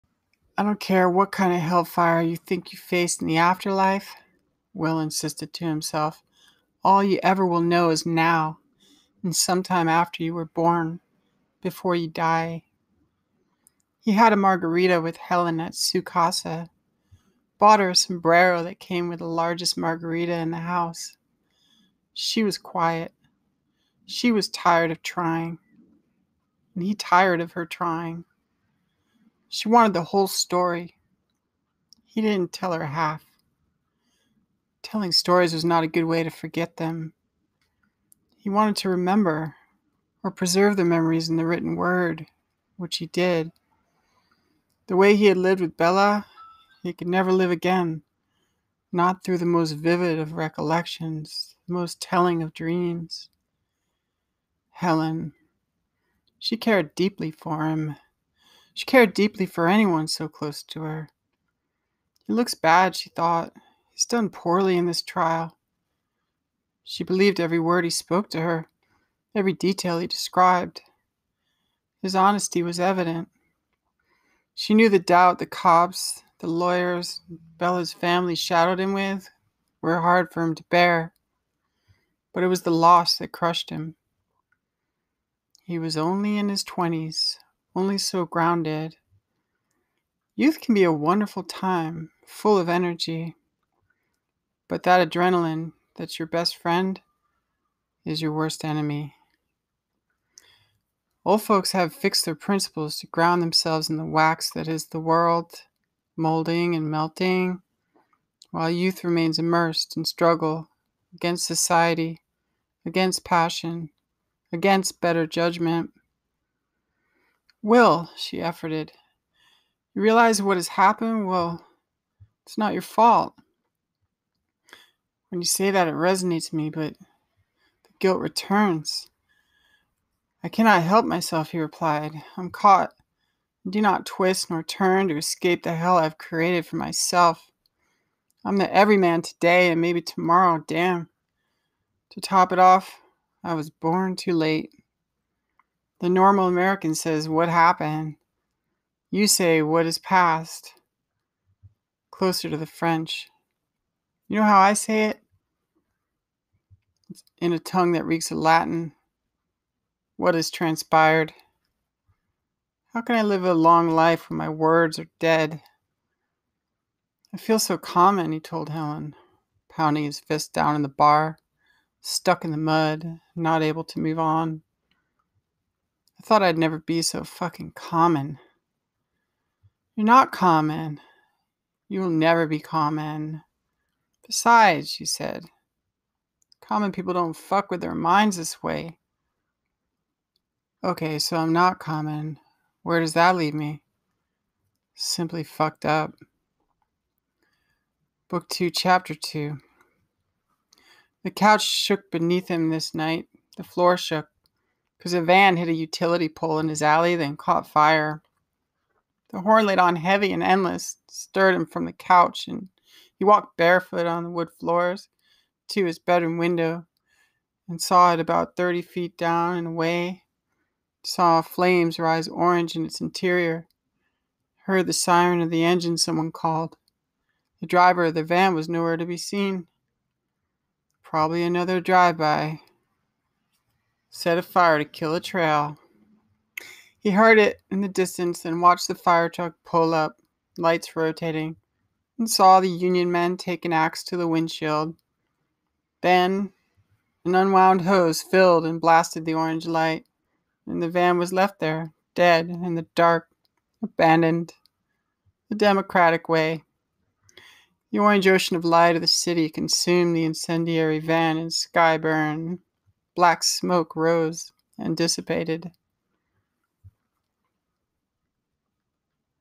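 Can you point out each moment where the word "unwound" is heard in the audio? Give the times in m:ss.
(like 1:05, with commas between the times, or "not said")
4:07.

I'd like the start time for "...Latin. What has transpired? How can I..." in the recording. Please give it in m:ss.
2:38.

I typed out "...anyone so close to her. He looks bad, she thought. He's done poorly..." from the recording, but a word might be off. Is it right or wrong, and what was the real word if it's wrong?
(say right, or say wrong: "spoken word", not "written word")
right.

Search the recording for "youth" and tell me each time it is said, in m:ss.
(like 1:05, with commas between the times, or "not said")
1:30, 1:48.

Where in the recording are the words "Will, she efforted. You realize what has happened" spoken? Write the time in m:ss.
1:57.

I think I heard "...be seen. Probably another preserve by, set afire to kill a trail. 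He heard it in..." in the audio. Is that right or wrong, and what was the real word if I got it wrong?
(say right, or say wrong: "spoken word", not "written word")
wrong: "drive", not "preserve".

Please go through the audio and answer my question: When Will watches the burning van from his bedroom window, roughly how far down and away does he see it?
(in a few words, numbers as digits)
30 feet.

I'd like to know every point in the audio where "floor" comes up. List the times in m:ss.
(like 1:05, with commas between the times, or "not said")
3:23, 3:34.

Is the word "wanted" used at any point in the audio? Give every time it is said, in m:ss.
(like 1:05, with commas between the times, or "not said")
0:29, 0:38.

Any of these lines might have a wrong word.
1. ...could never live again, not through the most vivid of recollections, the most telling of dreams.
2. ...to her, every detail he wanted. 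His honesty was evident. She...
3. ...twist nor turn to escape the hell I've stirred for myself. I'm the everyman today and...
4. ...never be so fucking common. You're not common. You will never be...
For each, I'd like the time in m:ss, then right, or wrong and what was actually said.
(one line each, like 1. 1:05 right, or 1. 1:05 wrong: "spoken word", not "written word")
1. 0:46 right
2. 1:08 wrong: "described", not "wanted"
3. 2:14 wrong: "created", not "stirred"
4. 2:56 right.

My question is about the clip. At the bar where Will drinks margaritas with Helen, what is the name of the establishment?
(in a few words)
Casa.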